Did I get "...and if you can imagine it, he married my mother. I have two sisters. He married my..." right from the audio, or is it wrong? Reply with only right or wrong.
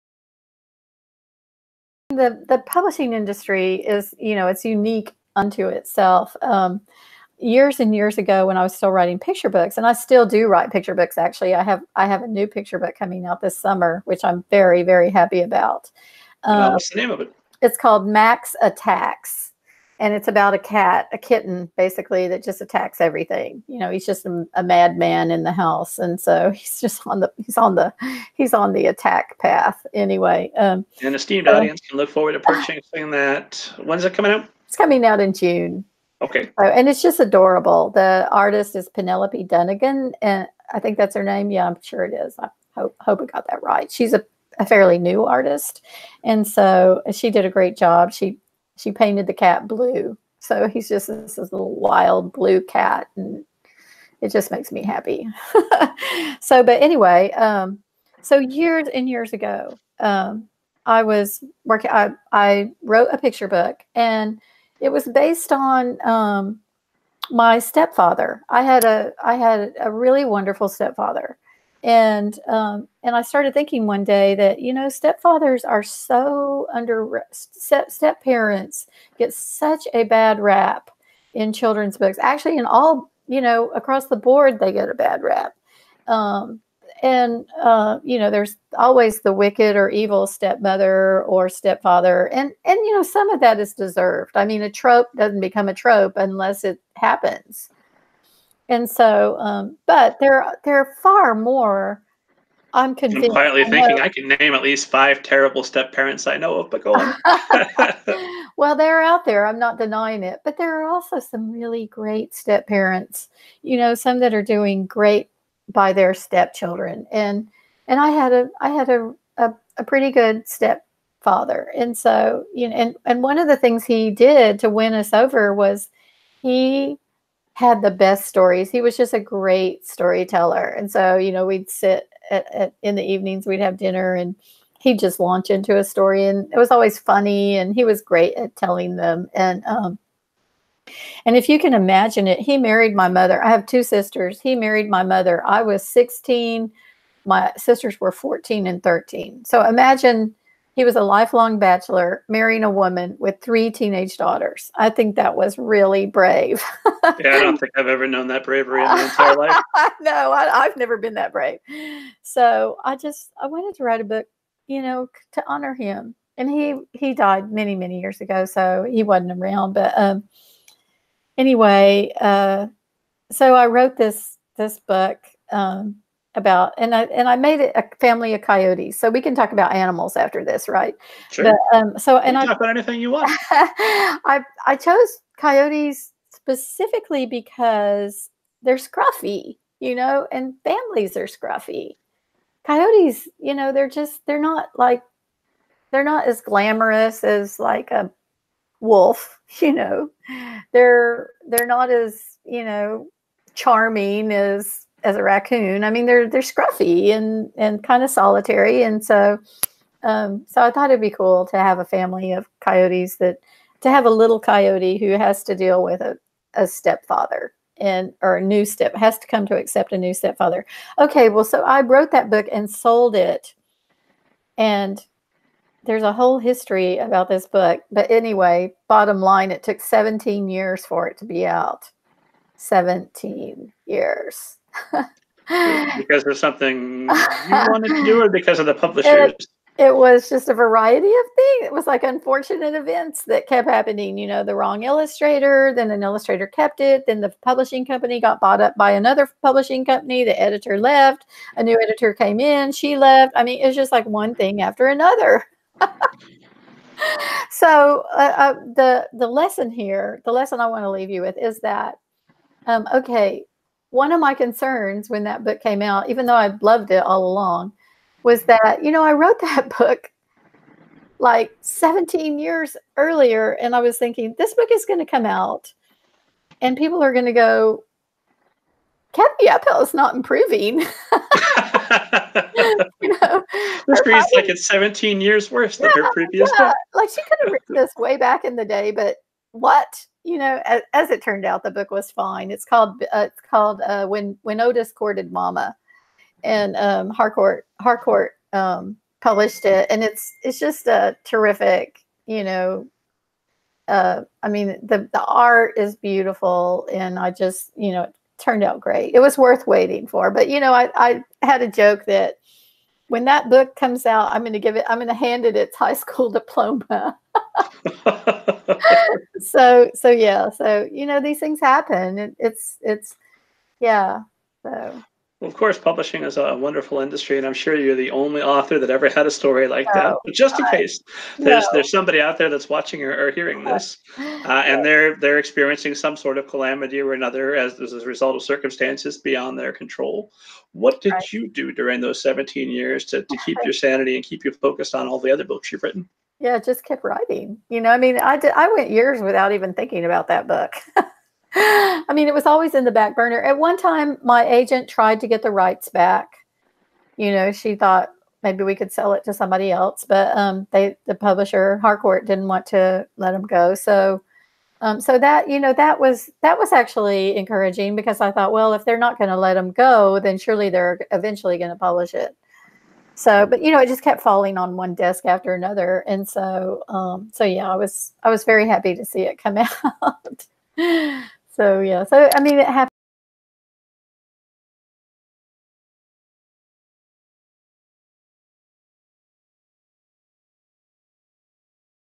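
right.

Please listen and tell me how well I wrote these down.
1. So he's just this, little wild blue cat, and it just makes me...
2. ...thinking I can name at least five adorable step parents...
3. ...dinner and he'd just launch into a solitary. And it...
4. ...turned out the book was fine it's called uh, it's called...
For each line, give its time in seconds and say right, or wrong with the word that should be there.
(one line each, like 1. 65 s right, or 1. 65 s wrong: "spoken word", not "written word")
1. 50 s right
2. 103 s wrong: "terrible", not "adorable"
3. 133 s wrong: "story", not "solitary"
4. 291 s right.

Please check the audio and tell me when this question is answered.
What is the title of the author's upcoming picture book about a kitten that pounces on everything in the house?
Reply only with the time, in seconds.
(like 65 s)
18 s.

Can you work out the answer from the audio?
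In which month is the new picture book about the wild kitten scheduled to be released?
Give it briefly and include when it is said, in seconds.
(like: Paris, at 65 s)
June, at 35 s.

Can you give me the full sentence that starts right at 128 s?
He was just a great storyteller.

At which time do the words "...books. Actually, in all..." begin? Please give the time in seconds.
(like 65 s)
81 s.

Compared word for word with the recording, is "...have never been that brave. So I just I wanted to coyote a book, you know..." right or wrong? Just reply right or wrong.
wrong.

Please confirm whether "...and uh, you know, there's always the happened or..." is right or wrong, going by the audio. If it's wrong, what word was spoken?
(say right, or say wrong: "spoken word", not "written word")
wrong: "wicked", not "happened".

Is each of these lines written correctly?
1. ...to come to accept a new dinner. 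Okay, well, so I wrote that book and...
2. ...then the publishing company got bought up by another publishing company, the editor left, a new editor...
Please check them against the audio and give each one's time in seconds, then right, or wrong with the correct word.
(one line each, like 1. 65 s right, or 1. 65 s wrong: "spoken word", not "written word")
1. 219 s wrong: "stepfather", not "dinner"
2. 247 s right.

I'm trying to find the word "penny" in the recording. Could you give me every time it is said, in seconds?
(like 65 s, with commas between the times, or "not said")
not said.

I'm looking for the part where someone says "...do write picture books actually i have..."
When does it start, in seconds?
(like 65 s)
10 s.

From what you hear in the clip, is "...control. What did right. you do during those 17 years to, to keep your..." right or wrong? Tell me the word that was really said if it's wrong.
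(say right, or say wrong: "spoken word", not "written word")
right.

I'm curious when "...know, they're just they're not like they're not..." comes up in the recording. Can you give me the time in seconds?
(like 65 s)
193 s.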